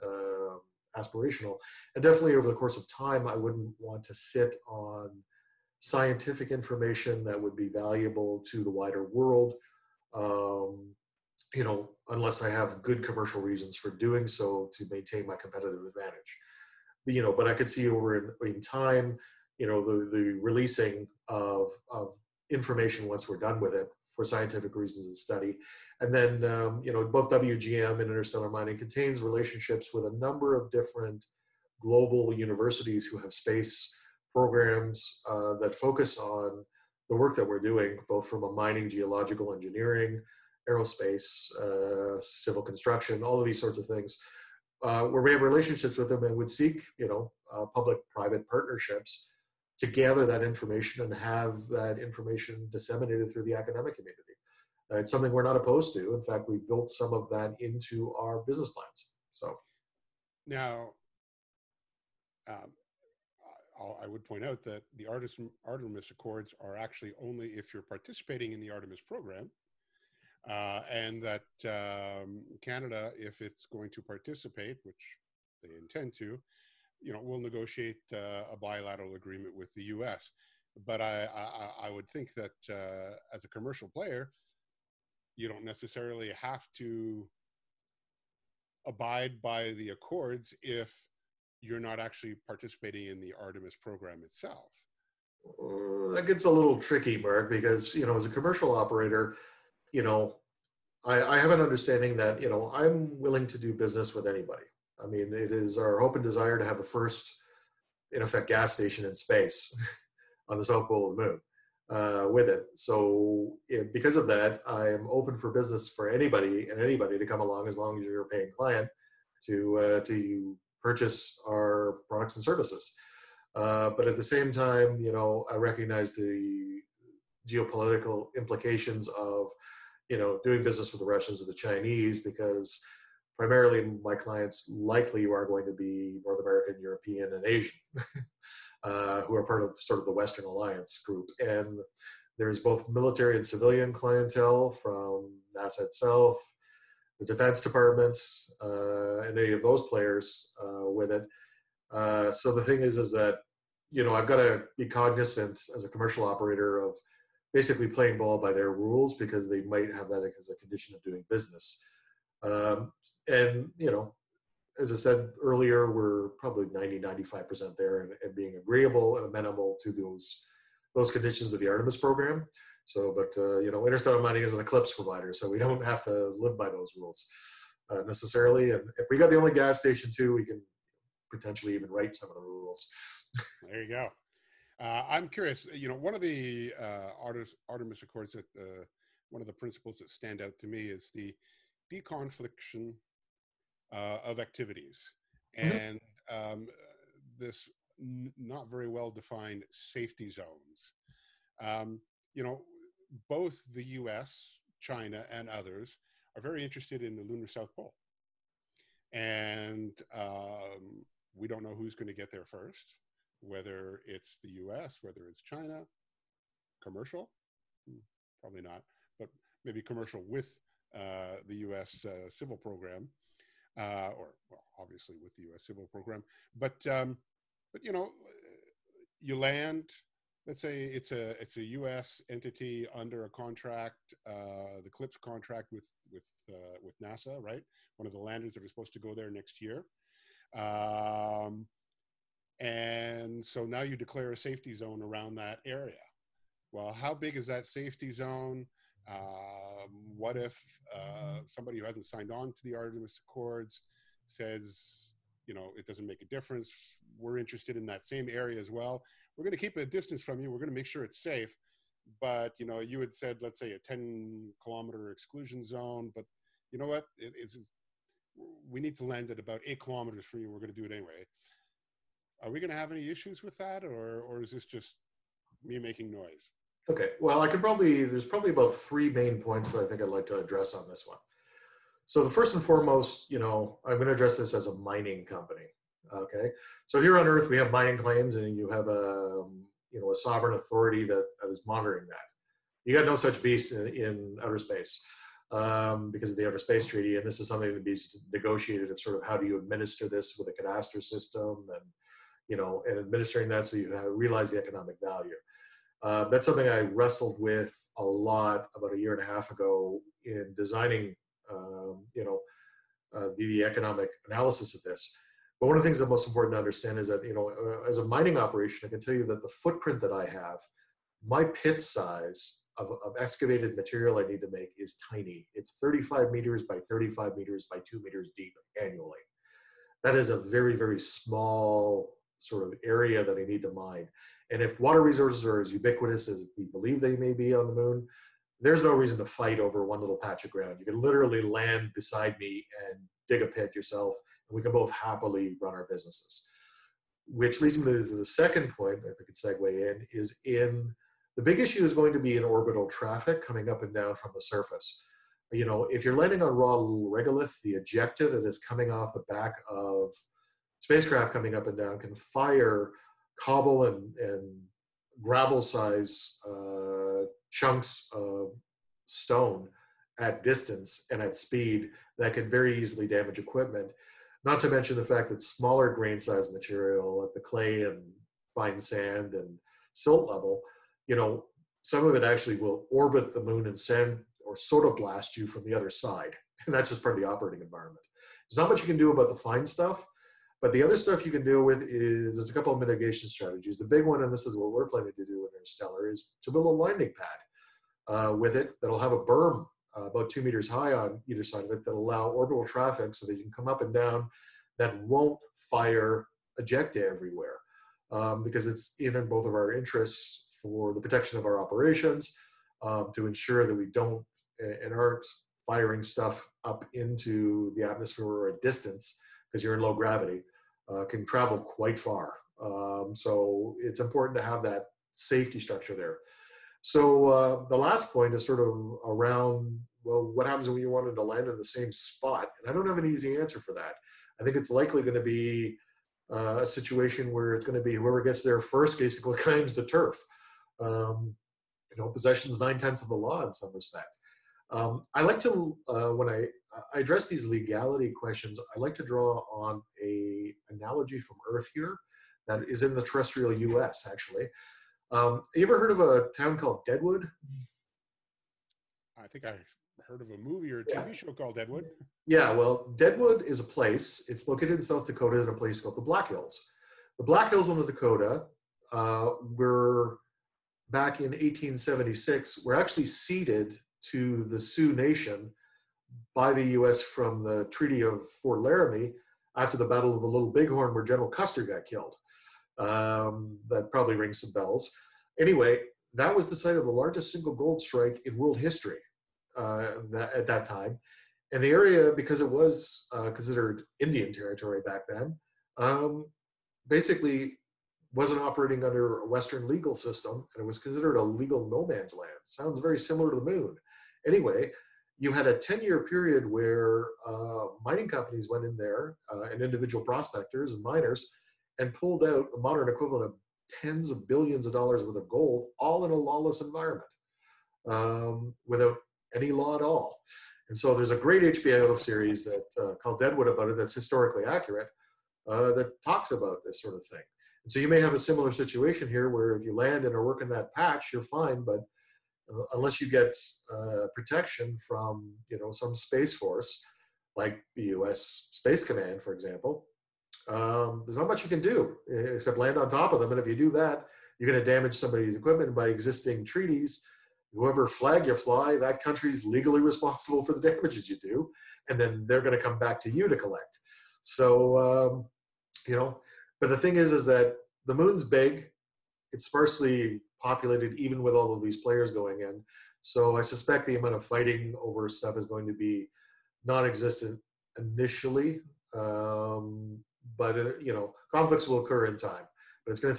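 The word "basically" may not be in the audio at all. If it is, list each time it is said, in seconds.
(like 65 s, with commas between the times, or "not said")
157 s, 438 s, 496 s.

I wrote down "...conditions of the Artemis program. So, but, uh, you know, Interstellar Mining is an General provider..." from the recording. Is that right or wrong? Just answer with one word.
wrong.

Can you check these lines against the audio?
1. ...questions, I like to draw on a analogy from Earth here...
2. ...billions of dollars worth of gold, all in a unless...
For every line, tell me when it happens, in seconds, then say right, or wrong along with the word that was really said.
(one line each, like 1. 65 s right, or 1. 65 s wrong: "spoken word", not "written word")
1. 448 s right
2. 514 s wrong: "lawless", not "unless".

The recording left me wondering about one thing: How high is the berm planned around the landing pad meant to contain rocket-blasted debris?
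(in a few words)
2 meters.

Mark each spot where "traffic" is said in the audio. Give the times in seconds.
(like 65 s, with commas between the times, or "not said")
352 s, 402 s.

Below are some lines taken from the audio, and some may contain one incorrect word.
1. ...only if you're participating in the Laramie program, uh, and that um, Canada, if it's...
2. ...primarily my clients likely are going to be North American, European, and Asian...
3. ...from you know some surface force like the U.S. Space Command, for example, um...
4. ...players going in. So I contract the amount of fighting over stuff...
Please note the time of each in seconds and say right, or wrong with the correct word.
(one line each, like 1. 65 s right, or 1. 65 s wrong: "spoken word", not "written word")
1. 67 s wrong: "Artemis", not "Laramie"
2. 133 s right
3. 534 s wrong: "space", not "surface"
4. 561 s wrong: "suspect", not "contract".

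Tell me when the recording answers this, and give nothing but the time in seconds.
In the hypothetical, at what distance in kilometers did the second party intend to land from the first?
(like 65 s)
269 s.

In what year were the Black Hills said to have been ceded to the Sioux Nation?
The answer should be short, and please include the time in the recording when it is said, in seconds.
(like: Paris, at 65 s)
1876, at 471 s.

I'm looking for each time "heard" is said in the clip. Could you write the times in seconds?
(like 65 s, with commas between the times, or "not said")
455 s, 460 s.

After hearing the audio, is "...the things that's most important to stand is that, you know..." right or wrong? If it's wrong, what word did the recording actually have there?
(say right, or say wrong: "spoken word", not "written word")
wrong: "understand", not "stand".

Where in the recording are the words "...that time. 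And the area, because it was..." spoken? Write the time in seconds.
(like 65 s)
490 s.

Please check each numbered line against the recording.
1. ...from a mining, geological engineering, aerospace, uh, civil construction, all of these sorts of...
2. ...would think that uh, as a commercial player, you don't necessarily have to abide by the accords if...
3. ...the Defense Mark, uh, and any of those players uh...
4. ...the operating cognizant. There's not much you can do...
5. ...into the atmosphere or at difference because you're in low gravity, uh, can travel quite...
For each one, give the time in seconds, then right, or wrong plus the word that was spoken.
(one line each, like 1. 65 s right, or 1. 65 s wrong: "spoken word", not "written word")
1. 38 s right
2. 81 s right
3. 147 s wrong: "Department", not "Mark"
4. 387 s wrong: "environment", not "cognizant"
5. 416 s wrong: "distance", not "difference".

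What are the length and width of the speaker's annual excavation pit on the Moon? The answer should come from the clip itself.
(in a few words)
35 by 35 meters.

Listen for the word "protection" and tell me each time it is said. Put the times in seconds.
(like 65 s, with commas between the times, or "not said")
410 s, 534 s.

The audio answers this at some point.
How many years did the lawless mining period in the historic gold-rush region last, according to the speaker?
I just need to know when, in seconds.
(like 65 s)
505 s.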